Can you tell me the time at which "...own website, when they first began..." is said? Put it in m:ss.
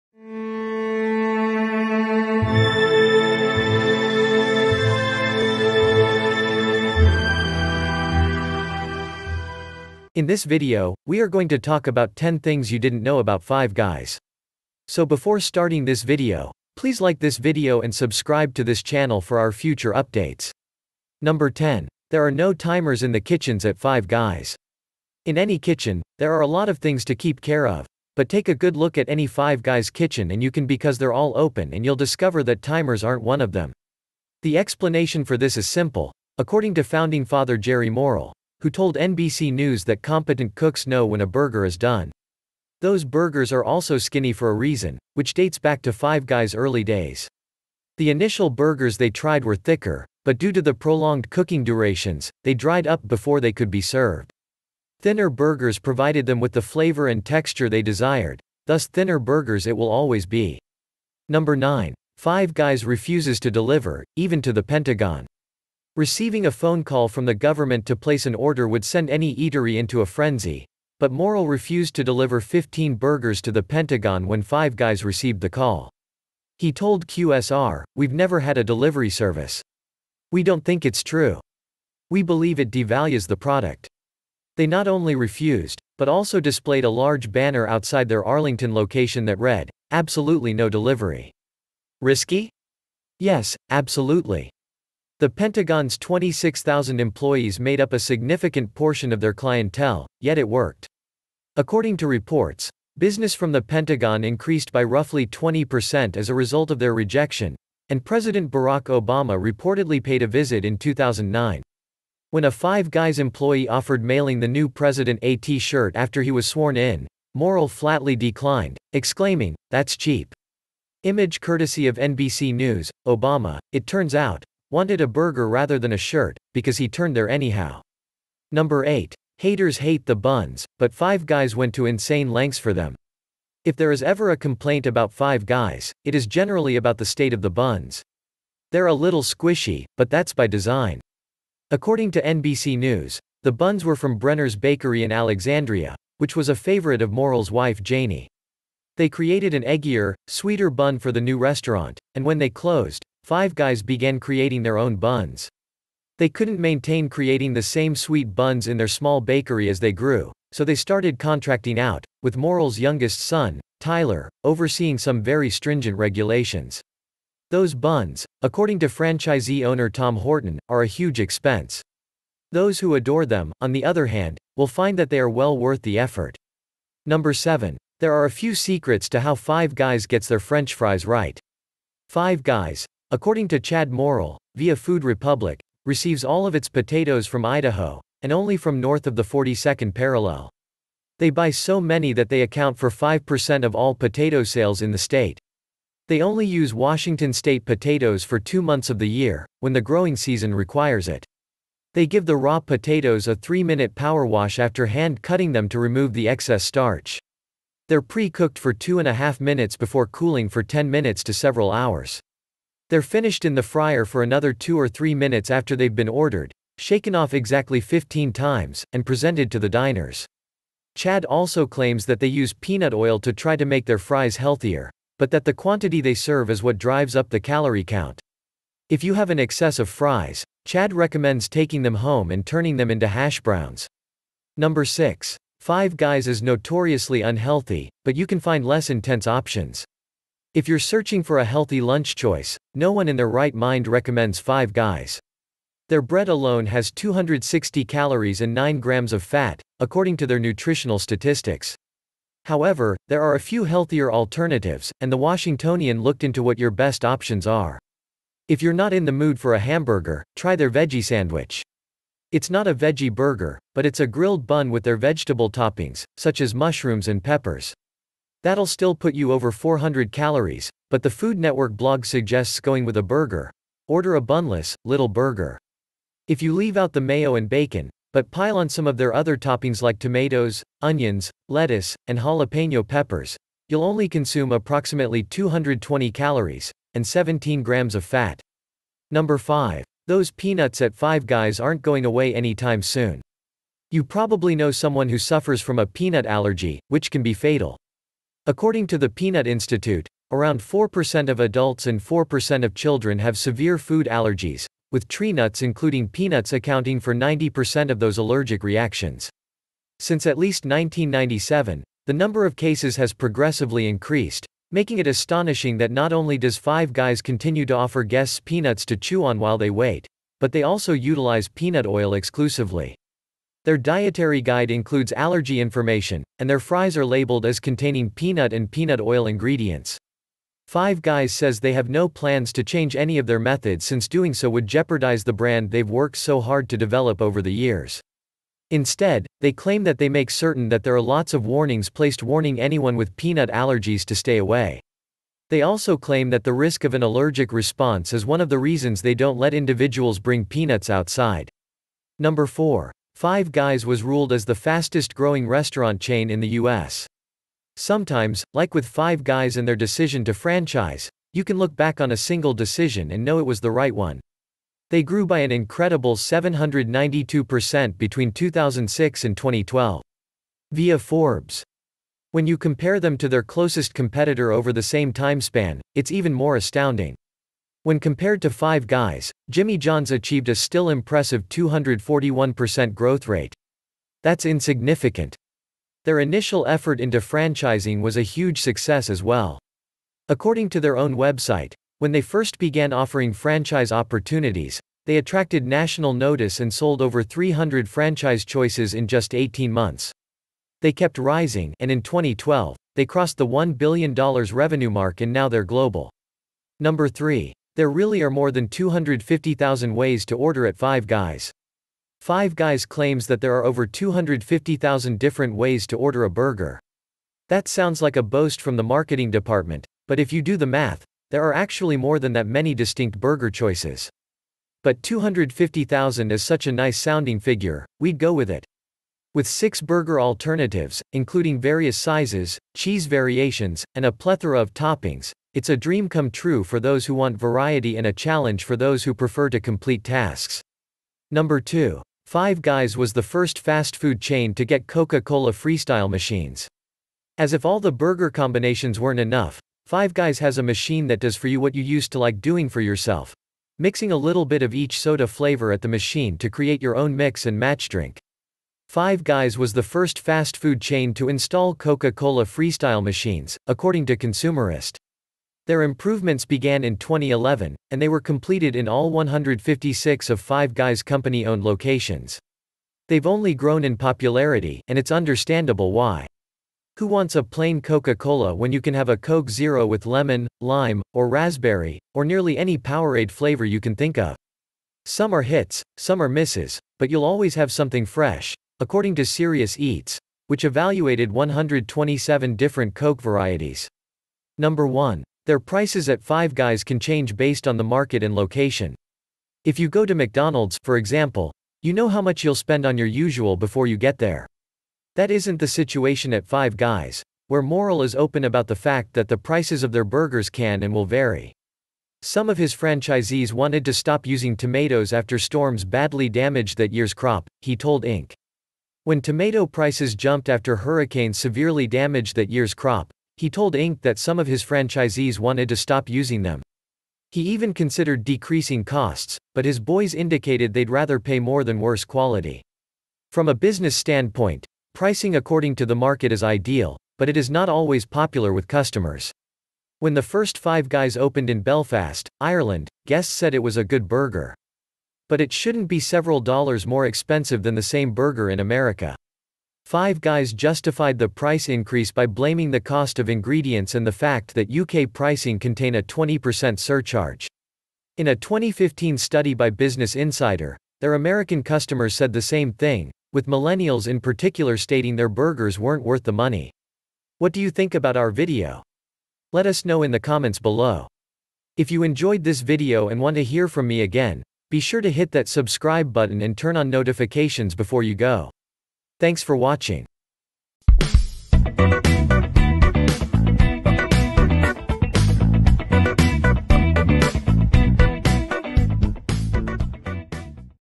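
6:30.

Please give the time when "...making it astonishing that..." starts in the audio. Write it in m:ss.
5:14.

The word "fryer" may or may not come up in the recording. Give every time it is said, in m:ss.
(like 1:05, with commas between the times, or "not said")
3:33.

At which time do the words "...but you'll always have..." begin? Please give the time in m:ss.
8:06.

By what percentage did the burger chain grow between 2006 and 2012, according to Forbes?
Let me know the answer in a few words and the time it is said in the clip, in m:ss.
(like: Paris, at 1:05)
792%, at 6:06.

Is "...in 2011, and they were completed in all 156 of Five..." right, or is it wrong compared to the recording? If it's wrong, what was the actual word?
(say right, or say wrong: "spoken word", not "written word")
right.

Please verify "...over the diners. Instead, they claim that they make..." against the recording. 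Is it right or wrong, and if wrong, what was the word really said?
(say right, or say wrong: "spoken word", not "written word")
wrong: "years", not "diners".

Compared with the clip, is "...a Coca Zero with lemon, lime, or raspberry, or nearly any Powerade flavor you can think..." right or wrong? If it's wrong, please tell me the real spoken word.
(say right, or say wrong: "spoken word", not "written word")
wrong: "Coke", not "Coca".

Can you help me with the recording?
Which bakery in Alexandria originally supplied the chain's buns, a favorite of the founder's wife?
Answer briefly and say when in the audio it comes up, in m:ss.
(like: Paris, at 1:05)
Brenner's Bakery, at 2:24.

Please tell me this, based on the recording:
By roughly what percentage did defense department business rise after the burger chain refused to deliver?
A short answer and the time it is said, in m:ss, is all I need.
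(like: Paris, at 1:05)
20%, at 1:44.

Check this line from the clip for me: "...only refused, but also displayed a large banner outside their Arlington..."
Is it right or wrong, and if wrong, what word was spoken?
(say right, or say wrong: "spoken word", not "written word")
right.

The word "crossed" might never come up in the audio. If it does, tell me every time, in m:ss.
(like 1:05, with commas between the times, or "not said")
6:43.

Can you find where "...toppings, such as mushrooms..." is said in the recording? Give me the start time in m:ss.
4:25.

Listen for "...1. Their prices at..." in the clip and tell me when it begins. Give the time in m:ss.
8:14.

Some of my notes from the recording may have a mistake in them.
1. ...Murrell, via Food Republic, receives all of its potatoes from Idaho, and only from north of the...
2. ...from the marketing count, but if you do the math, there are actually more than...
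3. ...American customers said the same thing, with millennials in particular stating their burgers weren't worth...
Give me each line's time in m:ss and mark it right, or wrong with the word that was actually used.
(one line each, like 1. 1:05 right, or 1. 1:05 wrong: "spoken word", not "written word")
1. 3:03 right
2. 6:58 wrong: "department", not "count"
3. 9:21 right.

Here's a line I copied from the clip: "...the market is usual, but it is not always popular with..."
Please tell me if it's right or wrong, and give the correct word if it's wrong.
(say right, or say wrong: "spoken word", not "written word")
wrong: "ideal", not "usual".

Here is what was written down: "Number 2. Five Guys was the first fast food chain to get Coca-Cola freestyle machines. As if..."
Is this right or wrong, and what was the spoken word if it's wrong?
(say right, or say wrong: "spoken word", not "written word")
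right.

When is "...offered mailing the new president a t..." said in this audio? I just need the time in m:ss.
1:53.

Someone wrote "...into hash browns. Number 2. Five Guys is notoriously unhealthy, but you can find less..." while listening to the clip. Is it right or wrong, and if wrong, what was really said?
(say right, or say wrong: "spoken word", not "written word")
wrong: "6", not "2".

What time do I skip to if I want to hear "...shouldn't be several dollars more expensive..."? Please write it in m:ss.
9:05.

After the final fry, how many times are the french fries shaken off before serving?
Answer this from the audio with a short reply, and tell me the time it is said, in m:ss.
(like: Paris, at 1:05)
15, at 3:37.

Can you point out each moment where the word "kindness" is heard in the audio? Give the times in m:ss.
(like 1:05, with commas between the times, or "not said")
not said.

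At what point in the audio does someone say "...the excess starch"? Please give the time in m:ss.
3:26.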